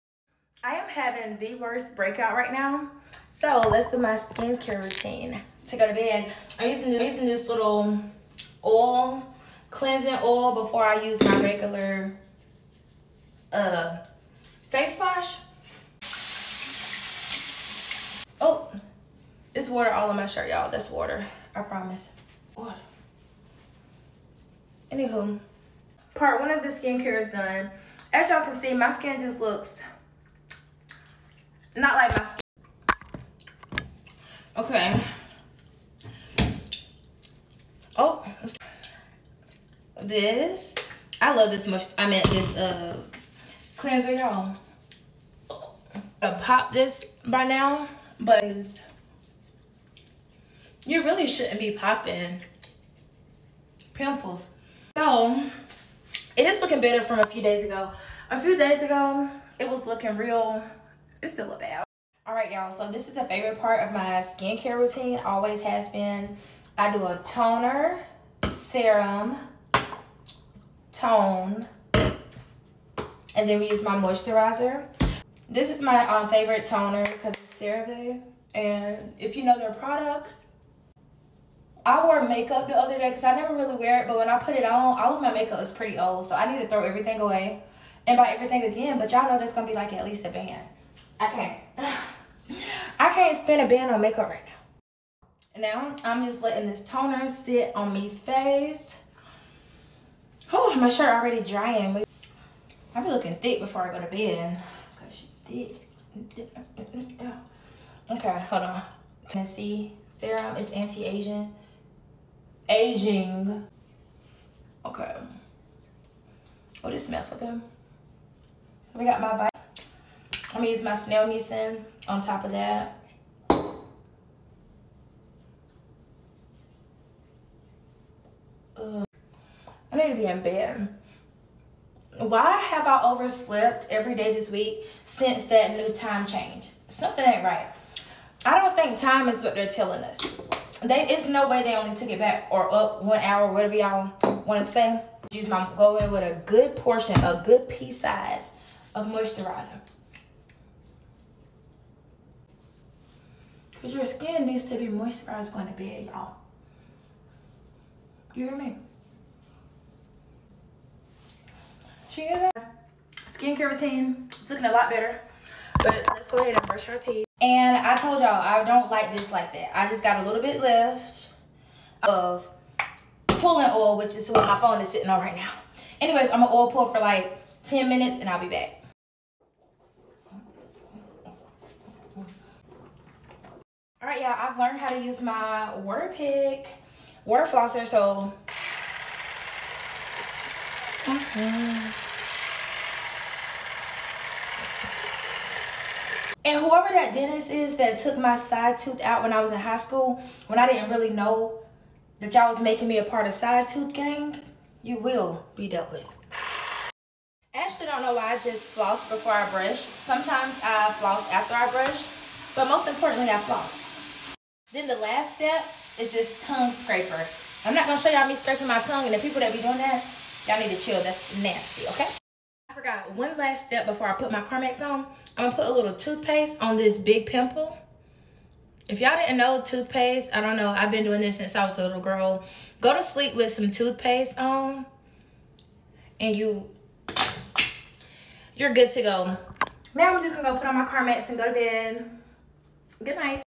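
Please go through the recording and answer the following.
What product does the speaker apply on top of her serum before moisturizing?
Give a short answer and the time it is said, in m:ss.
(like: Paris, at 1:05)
Snail mucin, at 2:00.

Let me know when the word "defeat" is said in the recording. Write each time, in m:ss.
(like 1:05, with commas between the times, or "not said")
not said.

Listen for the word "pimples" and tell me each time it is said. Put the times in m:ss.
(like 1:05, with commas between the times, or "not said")
0:53, 3:47.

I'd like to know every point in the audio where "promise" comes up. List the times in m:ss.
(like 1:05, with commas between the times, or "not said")
0:21.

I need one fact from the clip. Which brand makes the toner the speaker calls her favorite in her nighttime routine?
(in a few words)
CeraVe.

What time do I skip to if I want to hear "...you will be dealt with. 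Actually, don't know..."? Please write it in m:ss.
3:24.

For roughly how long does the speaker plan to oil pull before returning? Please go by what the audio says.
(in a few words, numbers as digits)
10 minutes.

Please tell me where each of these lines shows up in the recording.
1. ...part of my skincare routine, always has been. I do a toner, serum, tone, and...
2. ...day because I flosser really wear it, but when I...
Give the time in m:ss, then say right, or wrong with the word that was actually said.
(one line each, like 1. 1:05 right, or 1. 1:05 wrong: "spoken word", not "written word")
1. 1:03 right
2. 1:22 wrong: "never", not "flosser".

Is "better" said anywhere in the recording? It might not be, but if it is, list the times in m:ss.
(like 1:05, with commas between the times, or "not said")
0:56, 2:44.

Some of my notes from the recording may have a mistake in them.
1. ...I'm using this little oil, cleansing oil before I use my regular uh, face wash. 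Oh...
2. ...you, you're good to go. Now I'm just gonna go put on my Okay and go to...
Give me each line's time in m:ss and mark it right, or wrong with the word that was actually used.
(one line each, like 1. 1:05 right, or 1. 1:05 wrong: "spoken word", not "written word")
1. 0:06 right
2. 3:56 wrong: "Carmex", not "Okay".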